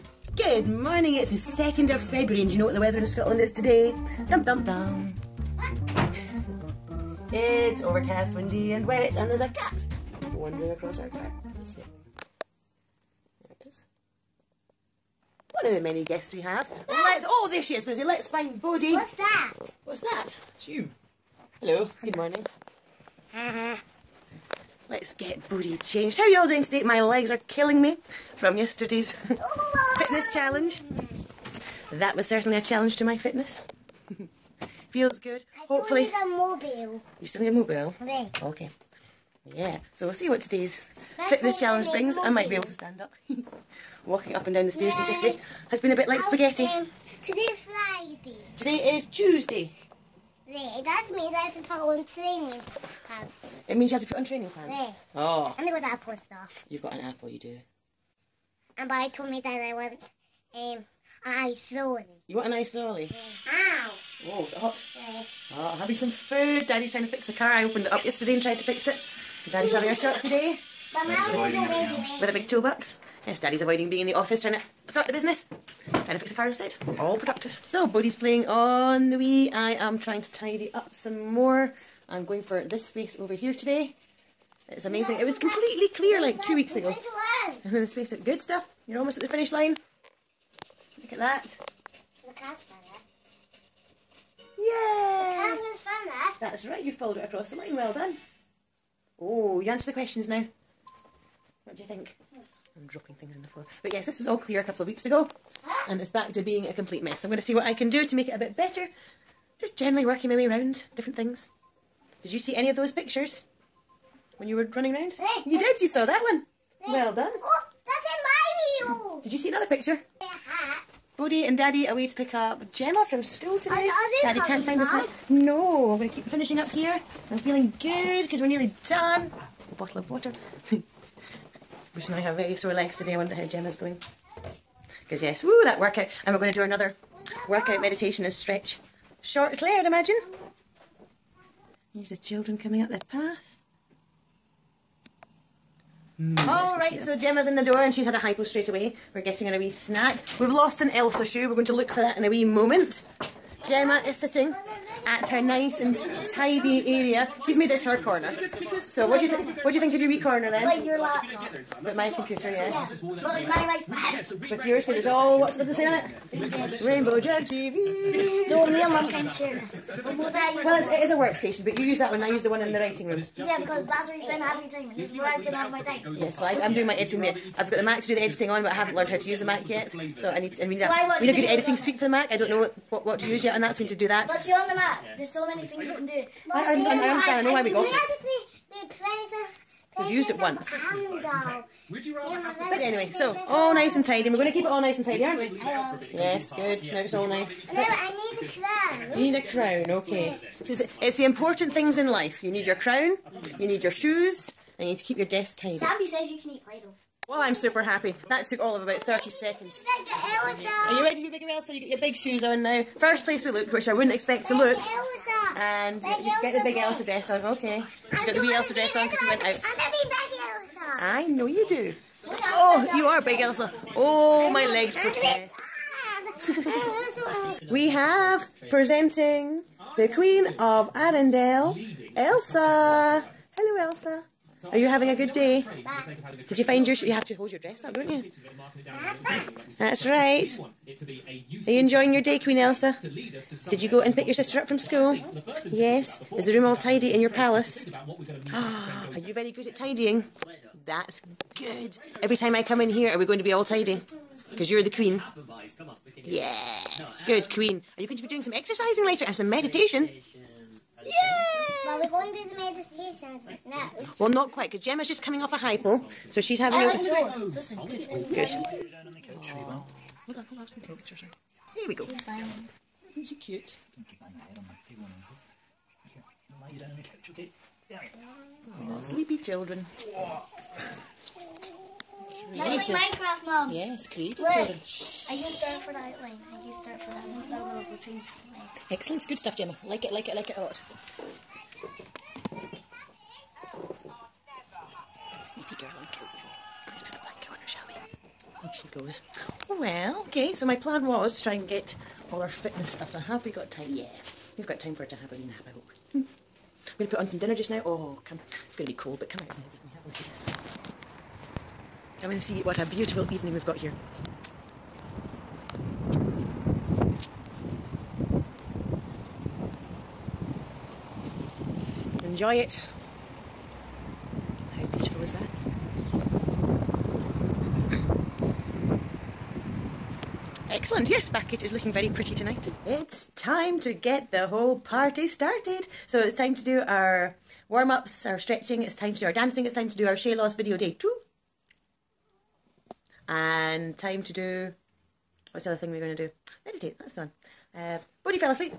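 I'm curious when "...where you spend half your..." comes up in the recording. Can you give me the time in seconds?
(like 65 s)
174 s.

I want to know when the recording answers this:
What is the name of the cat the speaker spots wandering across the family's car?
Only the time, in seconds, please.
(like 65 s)
17 s.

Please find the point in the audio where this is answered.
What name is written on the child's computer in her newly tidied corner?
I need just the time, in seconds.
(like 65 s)
166 s.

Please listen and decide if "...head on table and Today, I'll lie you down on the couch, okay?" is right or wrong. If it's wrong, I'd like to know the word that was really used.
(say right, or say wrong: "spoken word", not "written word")
wrong: "Here", not "Today".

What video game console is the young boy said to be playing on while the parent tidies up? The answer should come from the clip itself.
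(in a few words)
Wii.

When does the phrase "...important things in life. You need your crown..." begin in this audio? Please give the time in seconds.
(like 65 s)
201 s.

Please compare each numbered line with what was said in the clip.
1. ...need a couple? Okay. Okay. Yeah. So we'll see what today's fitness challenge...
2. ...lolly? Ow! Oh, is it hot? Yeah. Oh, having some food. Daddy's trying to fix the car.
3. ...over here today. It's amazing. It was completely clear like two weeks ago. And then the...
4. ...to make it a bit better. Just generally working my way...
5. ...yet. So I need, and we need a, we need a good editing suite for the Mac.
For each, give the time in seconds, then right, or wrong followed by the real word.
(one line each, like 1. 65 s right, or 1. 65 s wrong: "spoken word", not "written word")
1. 37 s wrong: "mobile", not "couple"
2. 62 s right
3. 83 s right
4. 108 s right
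5. 179 s right.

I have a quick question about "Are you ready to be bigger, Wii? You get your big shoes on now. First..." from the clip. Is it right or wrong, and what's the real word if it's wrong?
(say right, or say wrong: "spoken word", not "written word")
wrong: "Elsa", not "Wii".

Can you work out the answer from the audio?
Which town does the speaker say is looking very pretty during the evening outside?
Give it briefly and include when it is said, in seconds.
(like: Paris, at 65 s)
Bathgate, at 331 s.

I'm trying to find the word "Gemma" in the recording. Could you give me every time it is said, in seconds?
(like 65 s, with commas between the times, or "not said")
122 s, 133 s, 147 s, 153 s, 264 s, 289 s.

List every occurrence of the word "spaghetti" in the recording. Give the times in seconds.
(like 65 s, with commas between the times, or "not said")
46 s.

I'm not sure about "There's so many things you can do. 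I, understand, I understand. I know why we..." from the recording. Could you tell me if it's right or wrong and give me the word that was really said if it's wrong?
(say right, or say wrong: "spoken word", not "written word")
right.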